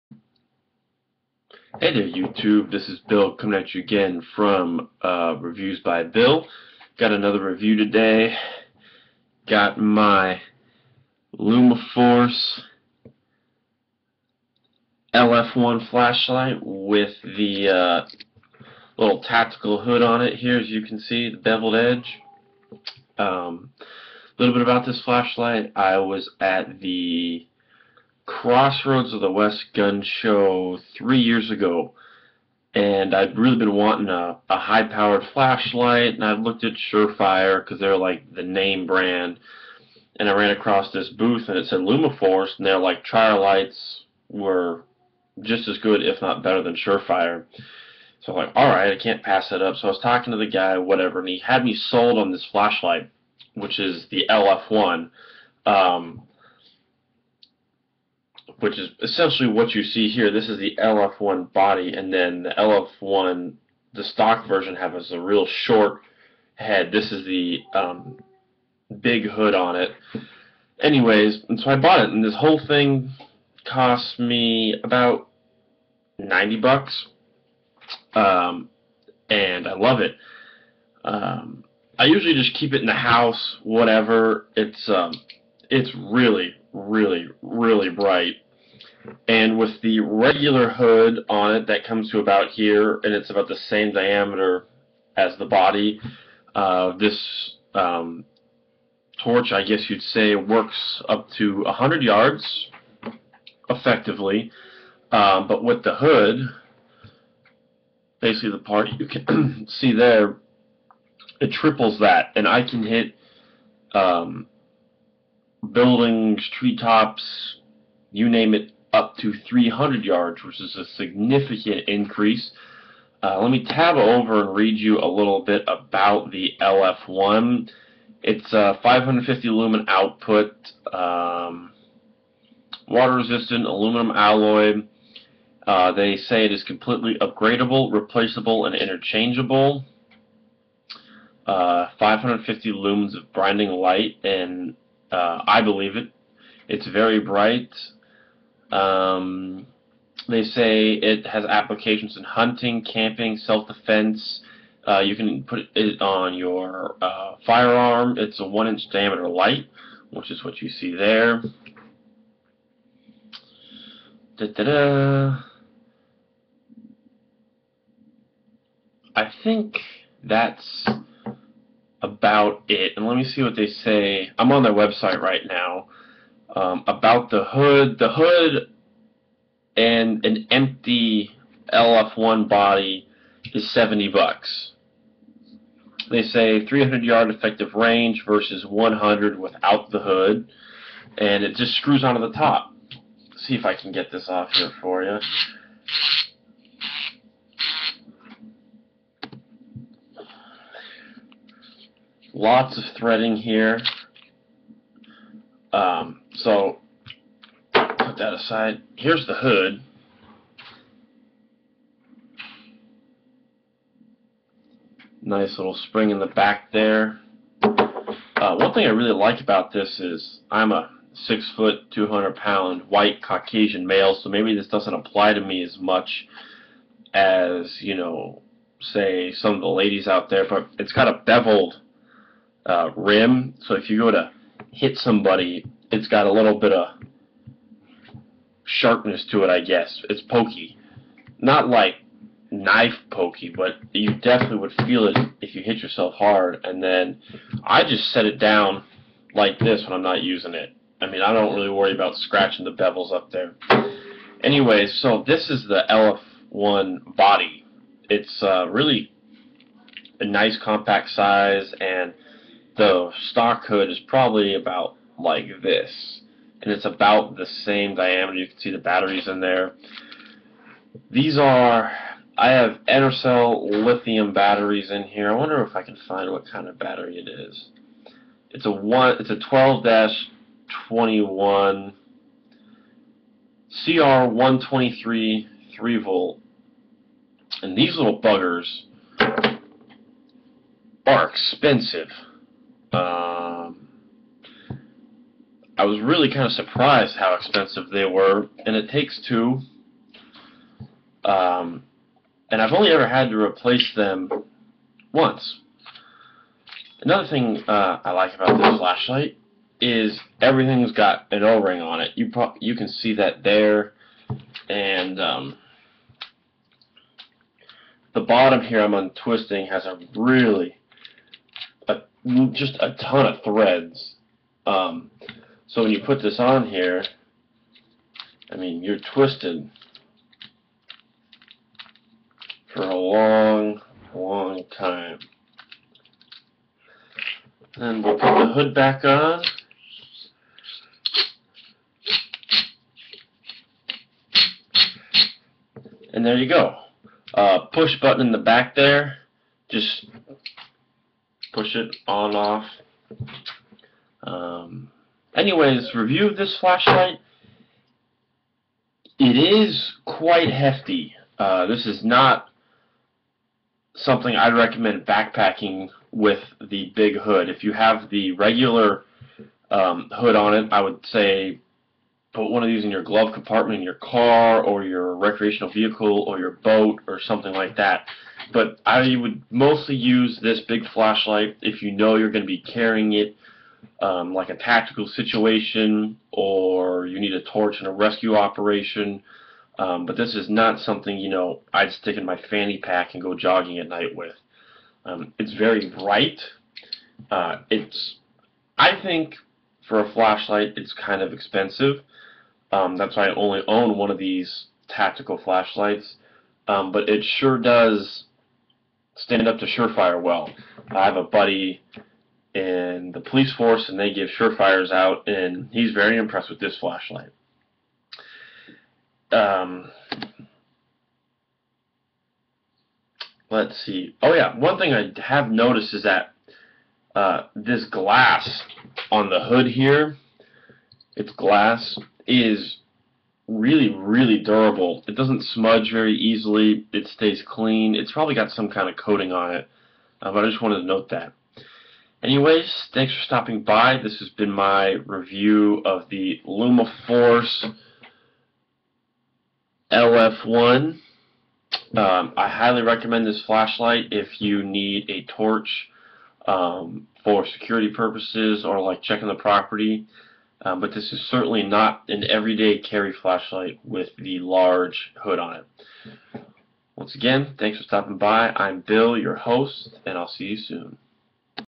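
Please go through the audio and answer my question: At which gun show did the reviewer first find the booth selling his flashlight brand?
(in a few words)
Crossroads of the West.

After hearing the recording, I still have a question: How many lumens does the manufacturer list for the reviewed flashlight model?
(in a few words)
550.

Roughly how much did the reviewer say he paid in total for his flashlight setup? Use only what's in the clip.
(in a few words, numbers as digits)
$90.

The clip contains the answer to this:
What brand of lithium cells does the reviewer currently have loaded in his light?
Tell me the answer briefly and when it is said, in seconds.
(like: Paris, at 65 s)
Enercell, at 272 s.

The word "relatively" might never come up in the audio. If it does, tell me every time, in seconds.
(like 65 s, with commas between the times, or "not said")
not said.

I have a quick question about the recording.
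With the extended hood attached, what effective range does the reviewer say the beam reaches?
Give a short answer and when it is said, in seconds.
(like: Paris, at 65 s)
300 yards, at 119 s.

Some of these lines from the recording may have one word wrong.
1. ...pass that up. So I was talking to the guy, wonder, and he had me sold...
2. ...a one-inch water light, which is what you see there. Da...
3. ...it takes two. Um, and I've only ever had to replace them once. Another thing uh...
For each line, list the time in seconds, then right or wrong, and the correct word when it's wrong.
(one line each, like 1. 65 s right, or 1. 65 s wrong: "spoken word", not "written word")
1. 49 s wrong: "whatever", not "wonder"
2. 158 s wrong: "diameter", not "water"
3. 298 s right.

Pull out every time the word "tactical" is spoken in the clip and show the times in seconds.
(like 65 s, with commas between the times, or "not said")
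19 s, 384 s, 404 s.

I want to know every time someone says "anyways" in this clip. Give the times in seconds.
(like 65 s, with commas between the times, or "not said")
70 s, 254 s, 355 s, 442 s.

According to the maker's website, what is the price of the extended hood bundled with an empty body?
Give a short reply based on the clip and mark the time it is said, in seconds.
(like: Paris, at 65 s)
$70, at 183 s.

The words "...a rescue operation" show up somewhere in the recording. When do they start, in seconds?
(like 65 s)
387 s.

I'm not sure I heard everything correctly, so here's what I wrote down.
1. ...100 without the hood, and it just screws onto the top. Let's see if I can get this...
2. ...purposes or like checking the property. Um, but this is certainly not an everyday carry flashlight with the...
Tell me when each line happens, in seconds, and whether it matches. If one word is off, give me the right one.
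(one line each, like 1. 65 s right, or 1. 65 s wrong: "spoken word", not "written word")
1. 188 s right
2. 457 s right.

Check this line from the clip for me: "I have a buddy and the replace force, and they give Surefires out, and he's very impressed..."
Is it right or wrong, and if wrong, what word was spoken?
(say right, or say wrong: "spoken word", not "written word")
wrong: "police", not "replace".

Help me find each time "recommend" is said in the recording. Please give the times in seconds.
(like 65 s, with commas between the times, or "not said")
364 s, 452 s.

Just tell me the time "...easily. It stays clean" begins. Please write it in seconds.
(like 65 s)
436 s.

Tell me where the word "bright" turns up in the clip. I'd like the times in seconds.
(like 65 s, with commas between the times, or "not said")
87 s, 147 s, 395 s.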